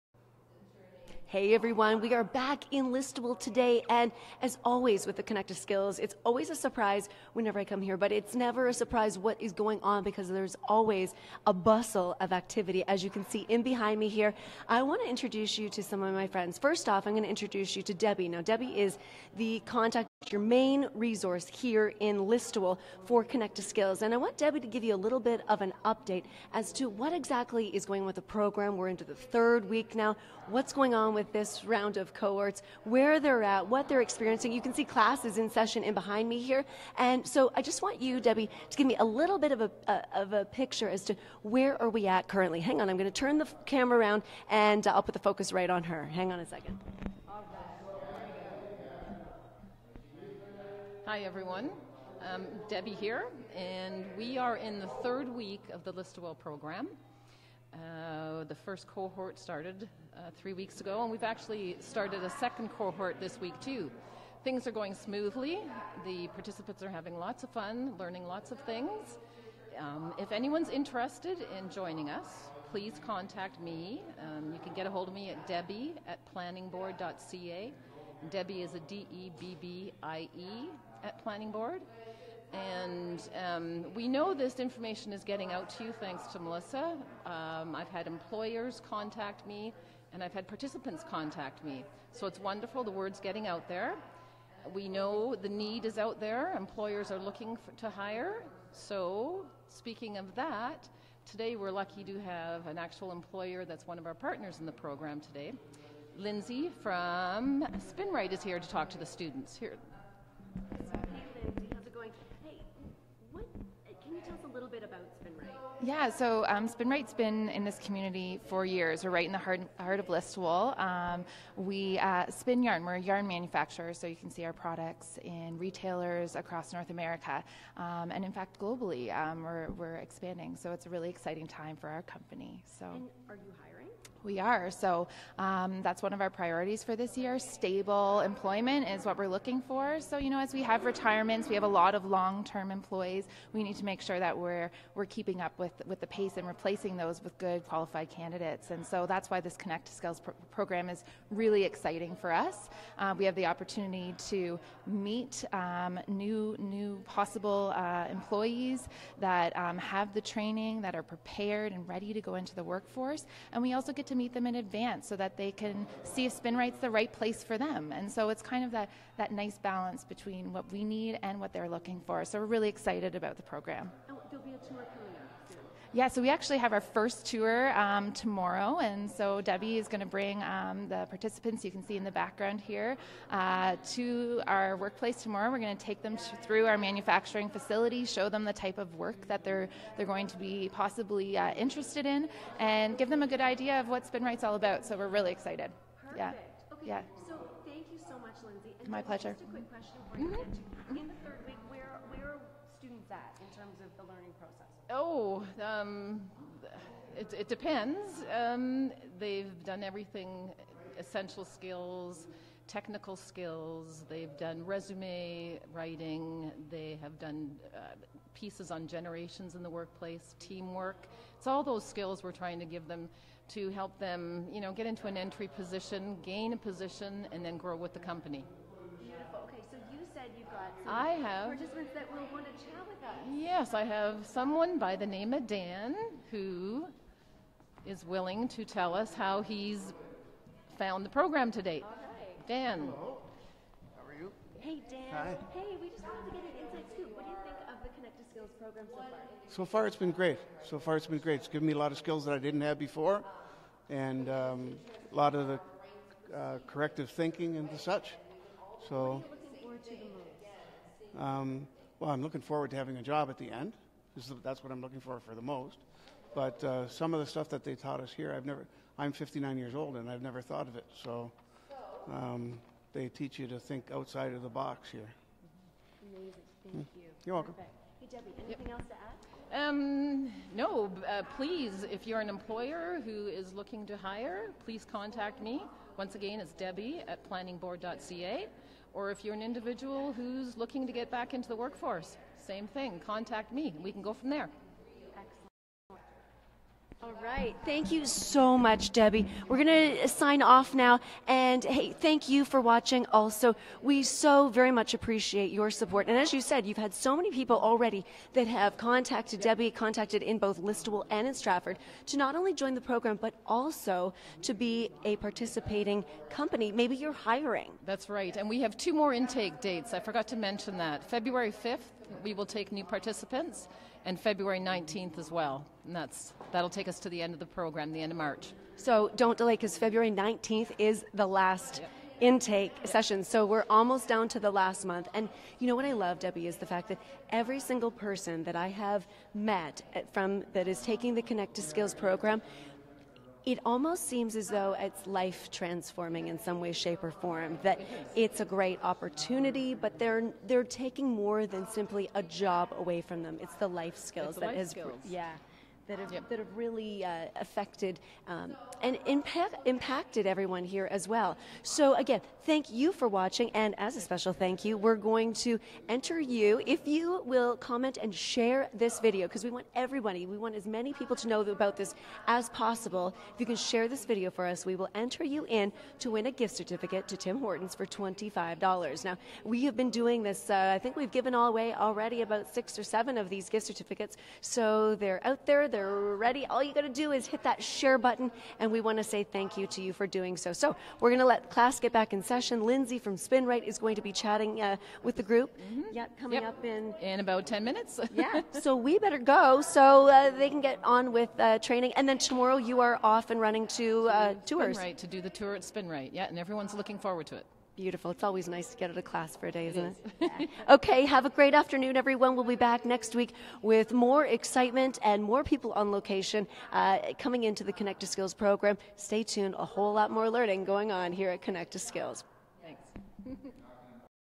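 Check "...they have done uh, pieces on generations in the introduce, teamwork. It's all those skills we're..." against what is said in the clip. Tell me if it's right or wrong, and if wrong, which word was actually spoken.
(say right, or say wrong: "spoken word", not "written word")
wrong: "workplace", not "introduce".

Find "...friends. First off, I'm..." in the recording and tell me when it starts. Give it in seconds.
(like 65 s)
16 s.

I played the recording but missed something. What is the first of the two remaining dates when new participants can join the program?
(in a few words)
February 5th.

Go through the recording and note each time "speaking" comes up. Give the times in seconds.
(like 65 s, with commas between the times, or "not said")
99 s.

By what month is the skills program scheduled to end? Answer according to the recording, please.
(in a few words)
March.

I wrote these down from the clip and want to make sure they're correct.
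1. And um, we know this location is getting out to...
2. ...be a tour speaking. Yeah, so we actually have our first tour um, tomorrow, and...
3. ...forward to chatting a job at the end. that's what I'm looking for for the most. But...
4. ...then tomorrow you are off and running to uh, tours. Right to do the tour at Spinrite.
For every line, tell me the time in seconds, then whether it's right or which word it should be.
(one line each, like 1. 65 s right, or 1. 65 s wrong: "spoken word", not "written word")
1. 82 s wrong: "information", not "location"
2. 174 s wrong: "coming", not "speaking"
3. 262 s wrong: "having", not "chatting"
4. 402 s right.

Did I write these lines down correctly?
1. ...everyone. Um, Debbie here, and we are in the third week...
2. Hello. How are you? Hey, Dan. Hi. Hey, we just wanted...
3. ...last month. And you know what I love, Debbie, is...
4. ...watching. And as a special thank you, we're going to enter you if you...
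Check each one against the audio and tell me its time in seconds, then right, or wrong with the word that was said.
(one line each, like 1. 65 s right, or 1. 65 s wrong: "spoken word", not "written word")
1. 51 s right
2. 242 s right
3. 334 s right
4. 363 s right.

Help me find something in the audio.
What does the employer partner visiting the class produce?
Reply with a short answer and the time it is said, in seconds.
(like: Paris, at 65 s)
yarn manufacturer, at 123 s.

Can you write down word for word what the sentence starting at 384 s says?
So, they're out there they're ready.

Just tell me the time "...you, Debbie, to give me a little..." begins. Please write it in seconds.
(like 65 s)
37 s.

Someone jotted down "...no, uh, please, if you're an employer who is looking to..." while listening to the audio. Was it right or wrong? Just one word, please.
right.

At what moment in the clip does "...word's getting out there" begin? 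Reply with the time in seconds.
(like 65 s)
92 s.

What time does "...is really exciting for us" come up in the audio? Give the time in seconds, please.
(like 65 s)
150 s.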